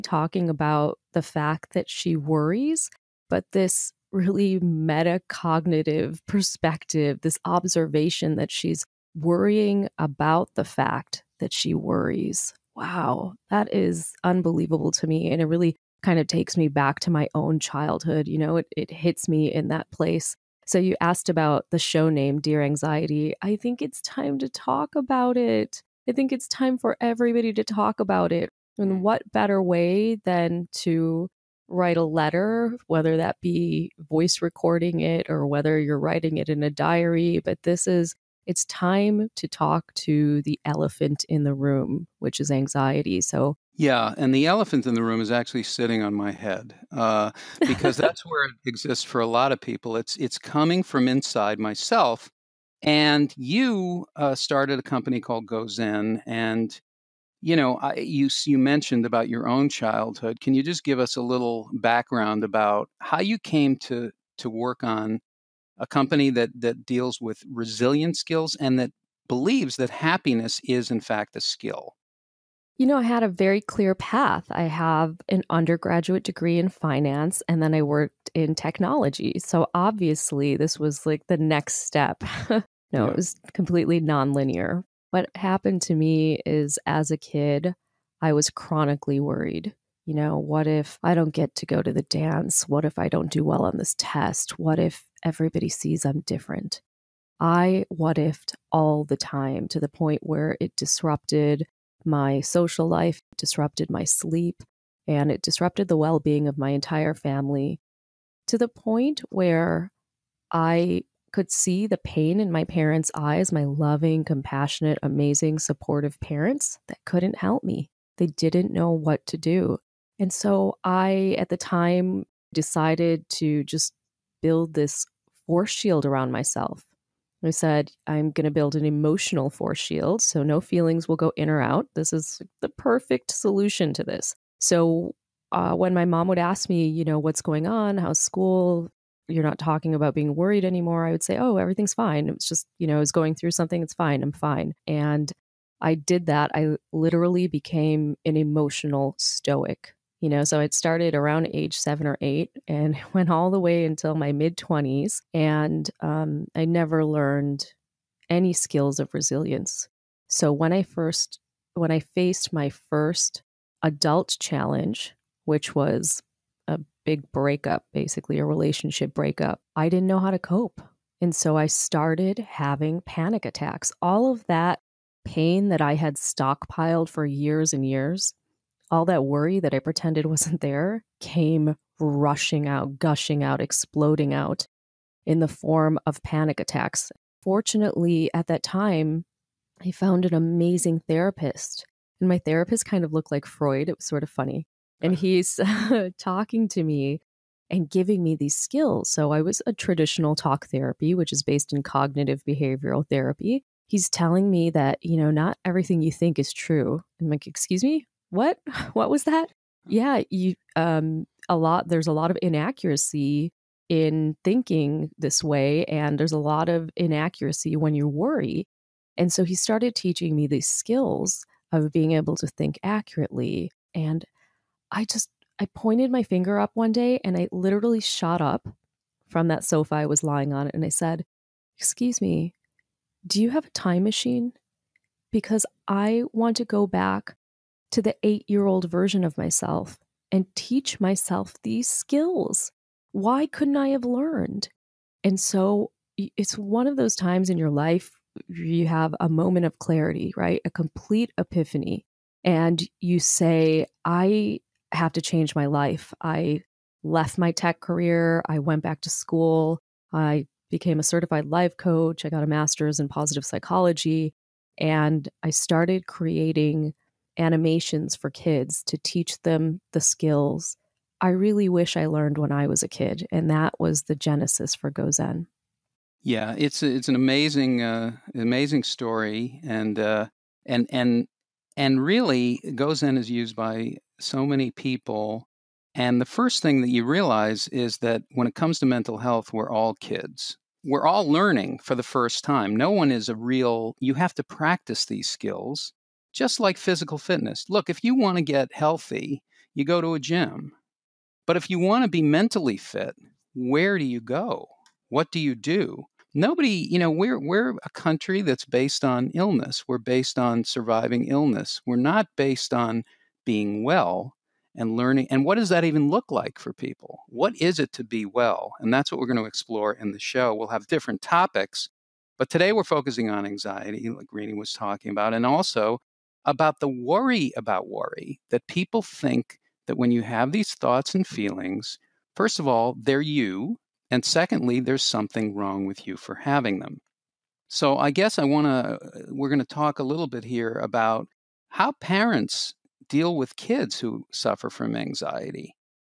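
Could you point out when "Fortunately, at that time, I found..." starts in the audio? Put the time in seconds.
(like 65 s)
187 s.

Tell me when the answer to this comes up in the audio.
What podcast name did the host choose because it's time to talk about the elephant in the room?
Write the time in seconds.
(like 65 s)
22 s.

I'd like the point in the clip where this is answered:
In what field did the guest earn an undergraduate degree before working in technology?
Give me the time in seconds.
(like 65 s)
76 s.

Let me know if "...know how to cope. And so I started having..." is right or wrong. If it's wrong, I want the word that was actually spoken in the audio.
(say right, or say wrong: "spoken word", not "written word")
right.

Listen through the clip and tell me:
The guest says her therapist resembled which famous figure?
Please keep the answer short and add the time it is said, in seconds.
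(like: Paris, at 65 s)
Freud, at 193 s.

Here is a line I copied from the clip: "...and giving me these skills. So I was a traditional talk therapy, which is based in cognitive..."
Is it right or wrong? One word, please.
right.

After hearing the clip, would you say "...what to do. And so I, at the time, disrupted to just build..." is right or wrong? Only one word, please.
wrong.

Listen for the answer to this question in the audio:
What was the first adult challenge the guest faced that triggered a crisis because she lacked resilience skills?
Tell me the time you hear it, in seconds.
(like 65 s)
166 s.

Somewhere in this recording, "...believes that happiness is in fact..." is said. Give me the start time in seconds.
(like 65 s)
69 s.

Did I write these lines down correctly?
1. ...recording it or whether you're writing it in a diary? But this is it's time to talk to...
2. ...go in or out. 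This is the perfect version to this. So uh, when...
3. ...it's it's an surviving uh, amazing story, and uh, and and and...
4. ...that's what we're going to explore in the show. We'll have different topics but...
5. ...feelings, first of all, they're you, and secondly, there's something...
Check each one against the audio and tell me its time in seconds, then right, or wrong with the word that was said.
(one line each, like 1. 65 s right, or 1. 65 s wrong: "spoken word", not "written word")
1. 34 s right
2. 131 s wrong: "solution", not "version"
3. 276 s wrong: "amazing", not "surviving"
4. 318 s right
5. 331 s right.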